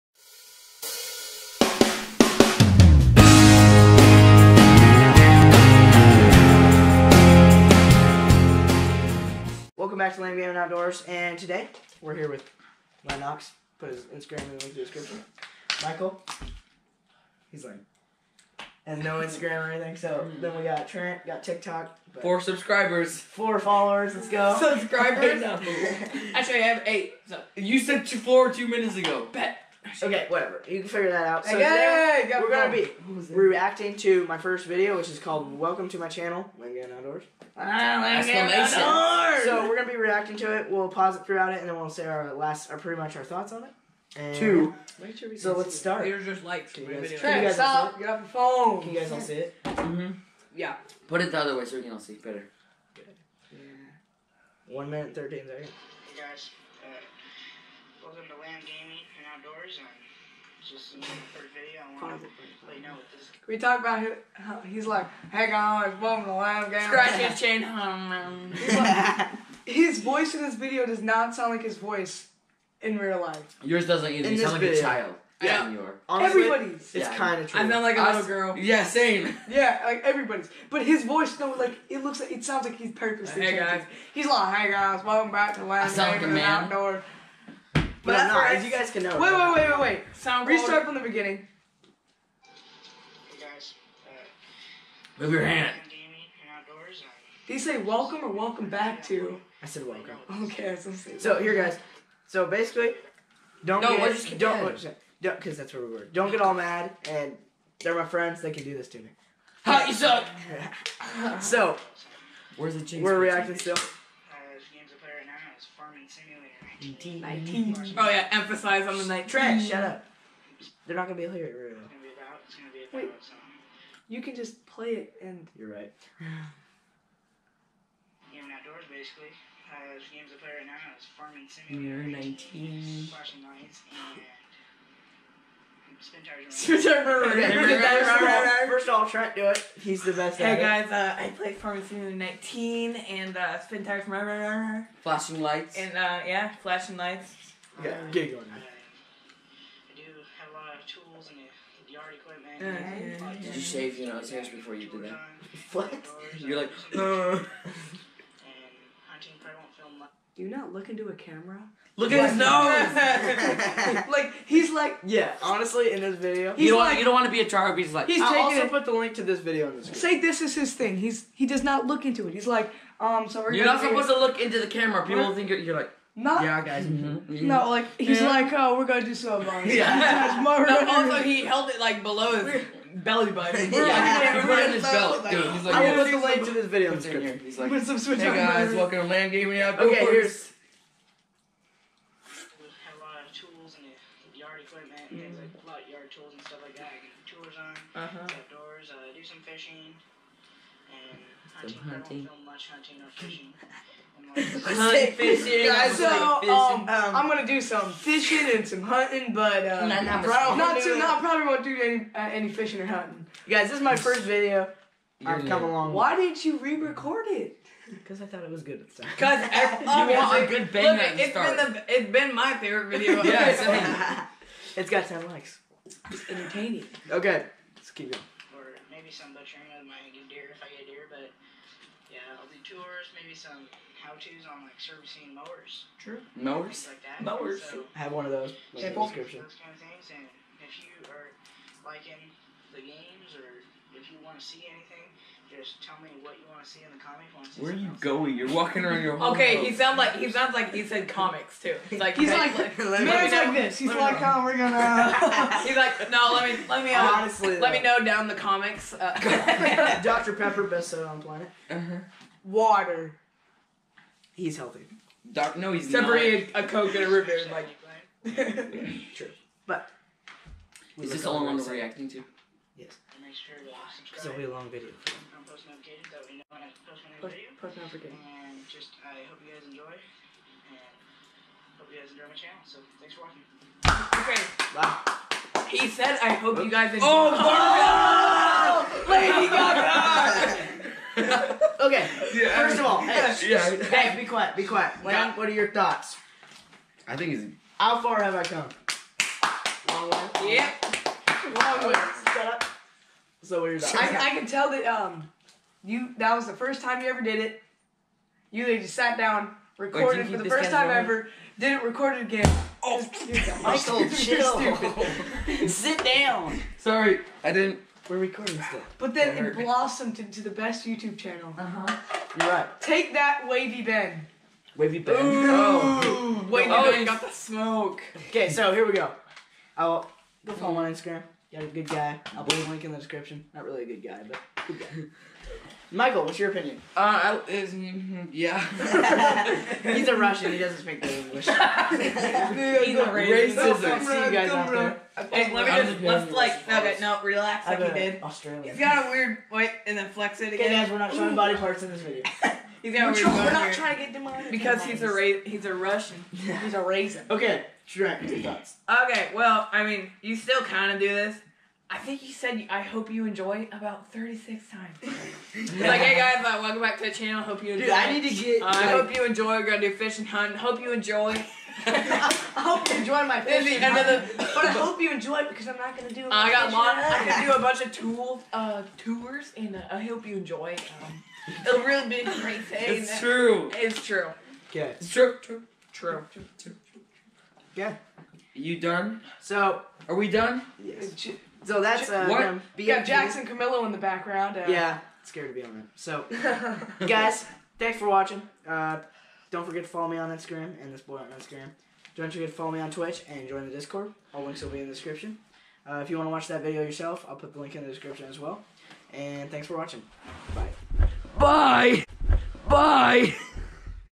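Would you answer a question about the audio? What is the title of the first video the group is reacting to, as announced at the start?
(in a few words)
Welcome to My Channel.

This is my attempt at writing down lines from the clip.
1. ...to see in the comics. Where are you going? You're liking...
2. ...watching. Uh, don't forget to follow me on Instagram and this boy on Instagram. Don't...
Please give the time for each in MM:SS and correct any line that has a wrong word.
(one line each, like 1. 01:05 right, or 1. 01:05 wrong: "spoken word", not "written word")
1. 04:06 wrong: "walking", not "liking"
2. 06:38 right.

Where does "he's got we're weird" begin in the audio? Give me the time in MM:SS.
05:52.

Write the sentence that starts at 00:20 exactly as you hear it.
then we got Trent, got TikTok.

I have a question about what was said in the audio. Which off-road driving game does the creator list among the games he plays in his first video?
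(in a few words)
Spintires.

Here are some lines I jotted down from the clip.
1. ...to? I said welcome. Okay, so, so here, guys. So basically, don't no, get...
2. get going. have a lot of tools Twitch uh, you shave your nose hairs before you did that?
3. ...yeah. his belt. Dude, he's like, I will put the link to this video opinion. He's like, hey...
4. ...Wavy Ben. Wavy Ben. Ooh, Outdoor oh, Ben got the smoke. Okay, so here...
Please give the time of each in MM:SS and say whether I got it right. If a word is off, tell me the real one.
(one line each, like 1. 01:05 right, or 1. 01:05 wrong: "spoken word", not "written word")
1. 01:39 right
2. 02:28 wrong: "Did", not "Twitch"
3. 03:04 wrong: "description", not "opinion"
4. 05:23 wrong: "Wavy", not "Outdoor".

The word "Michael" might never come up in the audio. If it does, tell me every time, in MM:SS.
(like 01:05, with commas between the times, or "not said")
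00:15, 05:13, 05:35.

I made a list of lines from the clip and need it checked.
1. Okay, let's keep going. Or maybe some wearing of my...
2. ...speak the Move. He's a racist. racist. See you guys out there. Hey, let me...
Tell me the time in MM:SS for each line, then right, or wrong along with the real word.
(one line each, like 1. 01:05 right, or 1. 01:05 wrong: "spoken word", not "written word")
1. 03:47 wrong: "butchering", not "wearing"
2. 05:40 wrong: "English", not "Move".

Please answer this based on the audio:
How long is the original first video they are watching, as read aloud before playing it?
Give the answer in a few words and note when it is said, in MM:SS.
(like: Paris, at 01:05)
1 minute 13 seconds, at 00:54.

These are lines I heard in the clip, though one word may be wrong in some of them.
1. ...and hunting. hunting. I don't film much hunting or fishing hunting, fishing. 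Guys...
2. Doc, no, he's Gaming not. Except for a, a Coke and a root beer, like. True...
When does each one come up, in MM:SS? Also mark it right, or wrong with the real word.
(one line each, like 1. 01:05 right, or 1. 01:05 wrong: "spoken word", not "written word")
1. 03:20 right
2. 04:25 wrong: "Except", not "Gaming".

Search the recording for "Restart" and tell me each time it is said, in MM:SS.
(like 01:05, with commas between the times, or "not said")
01:30.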